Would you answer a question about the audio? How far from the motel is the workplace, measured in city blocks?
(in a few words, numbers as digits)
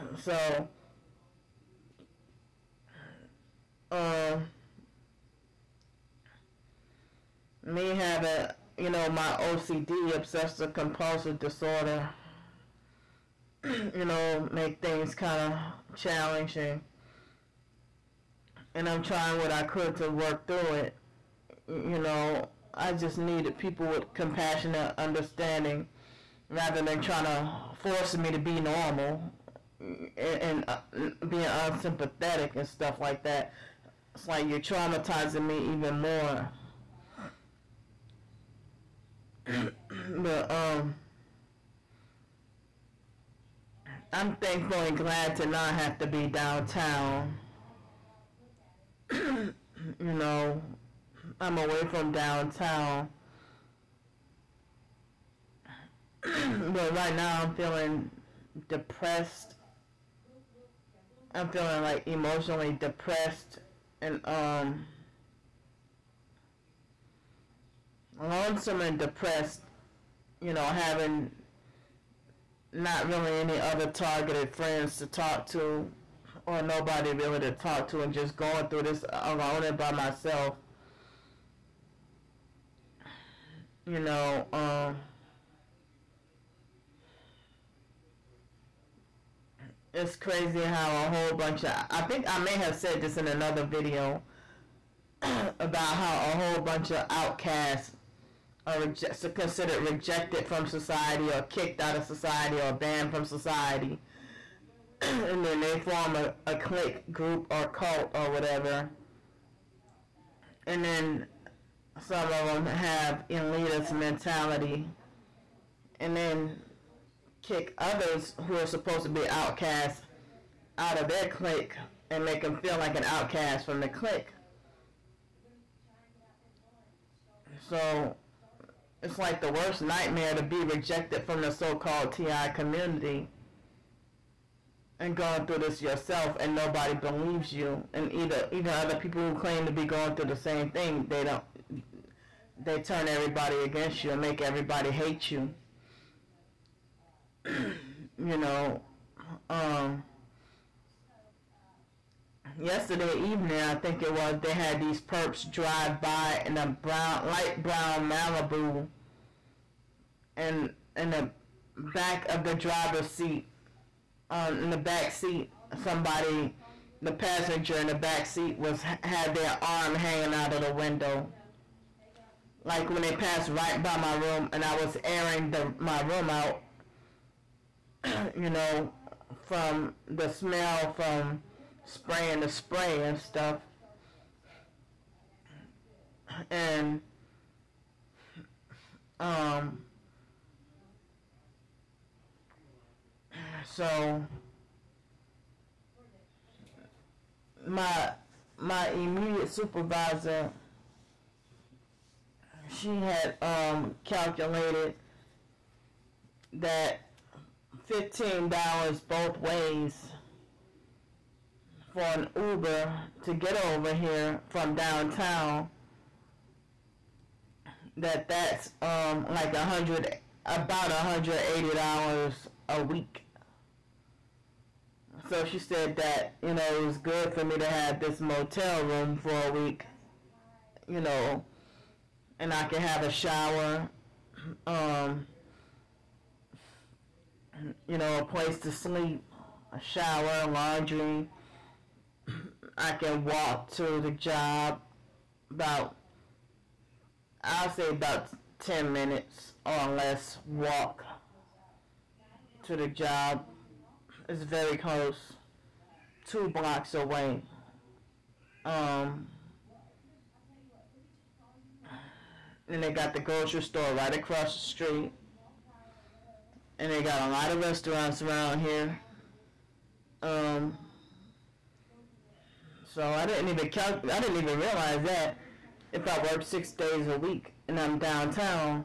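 2 blocks.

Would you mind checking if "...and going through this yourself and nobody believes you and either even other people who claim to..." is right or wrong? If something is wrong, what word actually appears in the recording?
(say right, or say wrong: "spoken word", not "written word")
right.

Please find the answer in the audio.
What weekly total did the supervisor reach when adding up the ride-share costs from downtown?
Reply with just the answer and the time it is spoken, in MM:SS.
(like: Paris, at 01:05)
$180, at 03:40.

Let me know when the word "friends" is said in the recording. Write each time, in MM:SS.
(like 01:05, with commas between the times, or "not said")
01:14.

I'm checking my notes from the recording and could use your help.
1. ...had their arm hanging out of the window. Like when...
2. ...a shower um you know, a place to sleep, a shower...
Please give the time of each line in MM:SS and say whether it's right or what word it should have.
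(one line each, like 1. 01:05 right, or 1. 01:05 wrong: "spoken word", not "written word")
1. 02:49 right
2. 03:53 right.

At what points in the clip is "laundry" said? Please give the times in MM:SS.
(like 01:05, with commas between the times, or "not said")
04:00.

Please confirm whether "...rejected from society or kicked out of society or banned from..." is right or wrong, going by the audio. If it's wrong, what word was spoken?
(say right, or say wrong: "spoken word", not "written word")
right.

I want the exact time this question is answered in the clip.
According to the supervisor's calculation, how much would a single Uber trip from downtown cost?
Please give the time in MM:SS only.
03:27.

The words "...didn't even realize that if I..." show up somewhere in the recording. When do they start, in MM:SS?
04:34.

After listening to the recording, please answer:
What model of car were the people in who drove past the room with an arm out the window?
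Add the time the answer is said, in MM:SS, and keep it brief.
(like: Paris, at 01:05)
Malibu, at 02:38.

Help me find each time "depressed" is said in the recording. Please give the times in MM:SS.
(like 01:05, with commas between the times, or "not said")
00:58, 01:02, 01:08.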